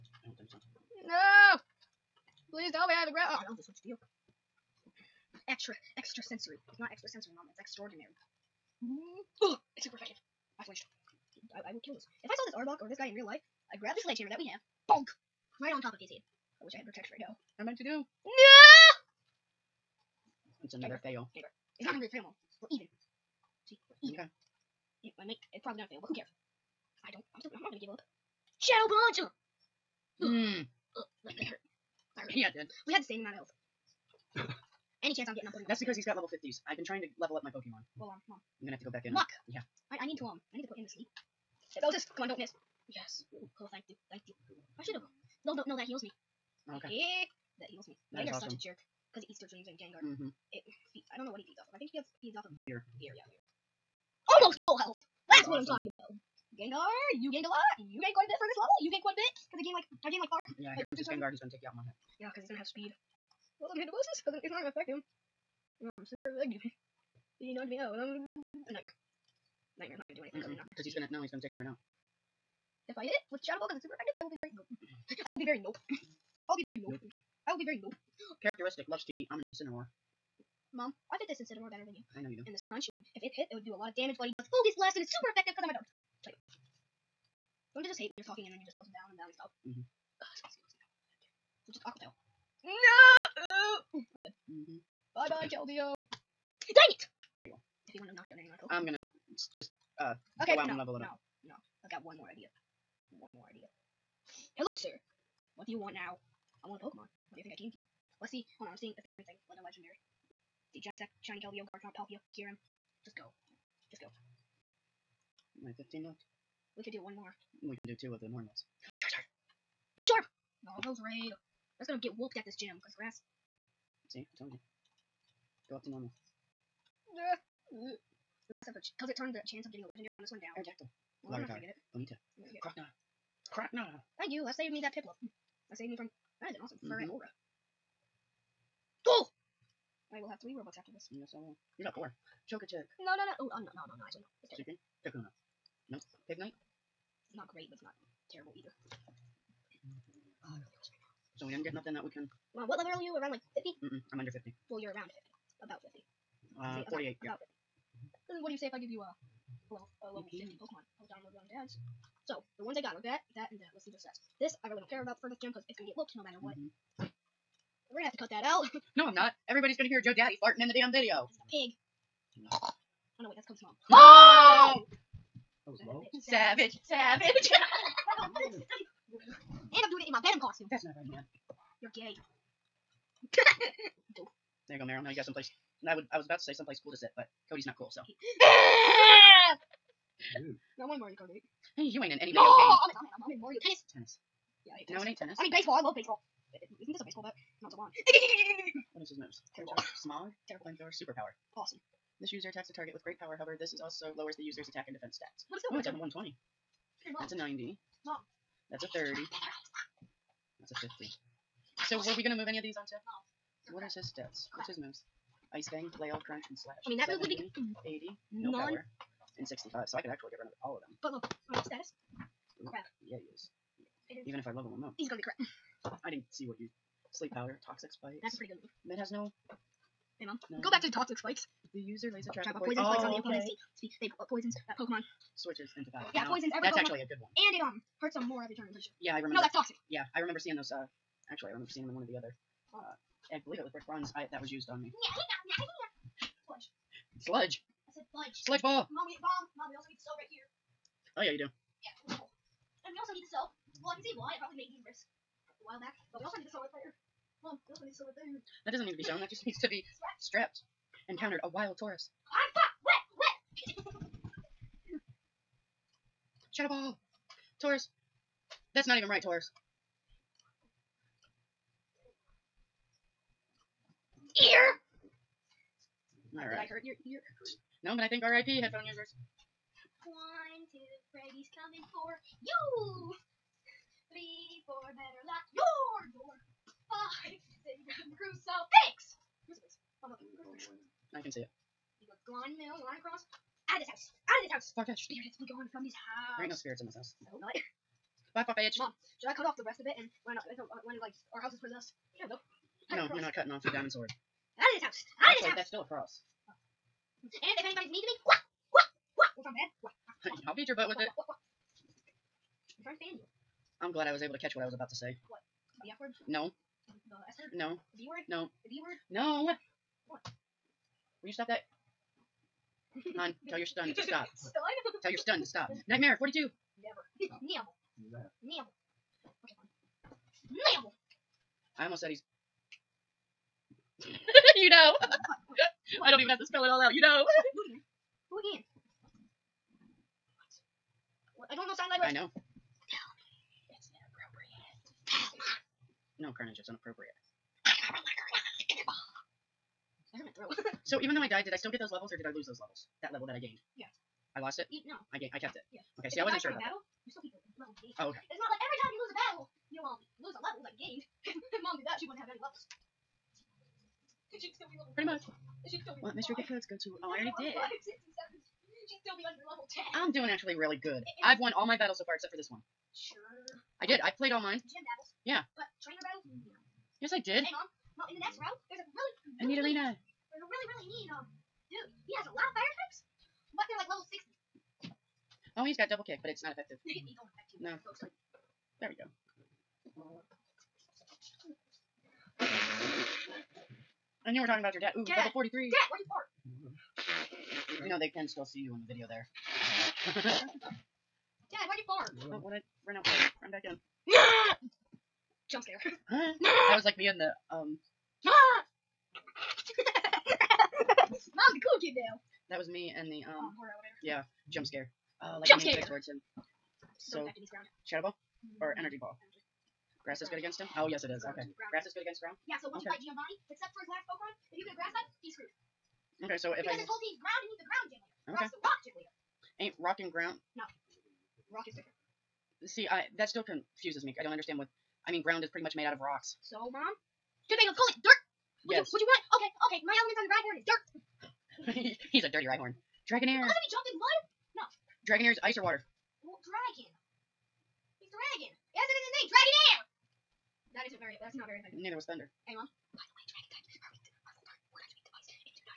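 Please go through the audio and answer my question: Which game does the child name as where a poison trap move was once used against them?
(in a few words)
Brick Bronze.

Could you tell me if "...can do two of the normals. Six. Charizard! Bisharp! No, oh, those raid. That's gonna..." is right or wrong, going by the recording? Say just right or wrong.
wrong.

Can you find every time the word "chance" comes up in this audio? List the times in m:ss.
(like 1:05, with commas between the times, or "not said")
0:35, 2:09.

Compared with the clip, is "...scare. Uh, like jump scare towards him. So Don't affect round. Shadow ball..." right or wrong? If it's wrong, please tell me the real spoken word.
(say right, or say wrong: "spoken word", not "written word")
wrong: "ground", not "round".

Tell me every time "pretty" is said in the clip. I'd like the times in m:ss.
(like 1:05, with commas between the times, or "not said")
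3:48, 3:58, 6:04, 7:15.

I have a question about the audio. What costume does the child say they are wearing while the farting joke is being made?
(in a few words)
Venom costume.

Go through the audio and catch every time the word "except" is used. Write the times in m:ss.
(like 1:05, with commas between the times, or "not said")
6:12, 7:03.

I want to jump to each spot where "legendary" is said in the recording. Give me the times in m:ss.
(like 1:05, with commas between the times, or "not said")
1:49, 2:09.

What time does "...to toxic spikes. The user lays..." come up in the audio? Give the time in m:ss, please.
3:50.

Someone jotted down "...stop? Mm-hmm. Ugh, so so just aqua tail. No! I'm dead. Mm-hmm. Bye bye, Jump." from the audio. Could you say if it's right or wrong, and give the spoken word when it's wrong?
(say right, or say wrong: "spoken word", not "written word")
wrong: "Keldeo", not "Jump".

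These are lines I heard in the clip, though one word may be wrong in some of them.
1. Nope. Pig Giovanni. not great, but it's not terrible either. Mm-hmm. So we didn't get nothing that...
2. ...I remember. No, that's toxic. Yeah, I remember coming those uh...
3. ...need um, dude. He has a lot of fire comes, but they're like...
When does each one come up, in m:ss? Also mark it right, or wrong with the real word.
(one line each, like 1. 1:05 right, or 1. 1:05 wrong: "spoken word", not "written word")
1. 2:25 wrong: "Knight", not "Giovanni"
2. 3:59 wrong: "seeing", not "coming"
3. 6:20 wrong: "types", not "comes".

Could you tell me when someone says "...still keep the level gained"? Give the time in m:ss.
5:57.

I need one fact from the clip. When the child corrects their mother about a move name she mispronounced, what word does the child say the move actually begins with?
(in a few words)
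Extraordinary.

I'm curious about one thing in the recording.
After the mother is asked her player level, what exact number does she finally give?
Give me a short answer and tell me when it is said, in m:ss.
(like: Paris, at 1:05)
48, at 2:36.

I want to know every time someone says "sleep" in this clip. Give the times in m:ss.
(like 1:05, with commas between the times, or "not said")
0:40, 3:47.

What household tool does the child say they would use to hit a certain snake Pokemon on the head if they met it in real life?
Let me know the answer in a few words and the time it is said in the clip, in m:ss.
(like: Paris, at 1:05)
Sledgehammer, at 0:14.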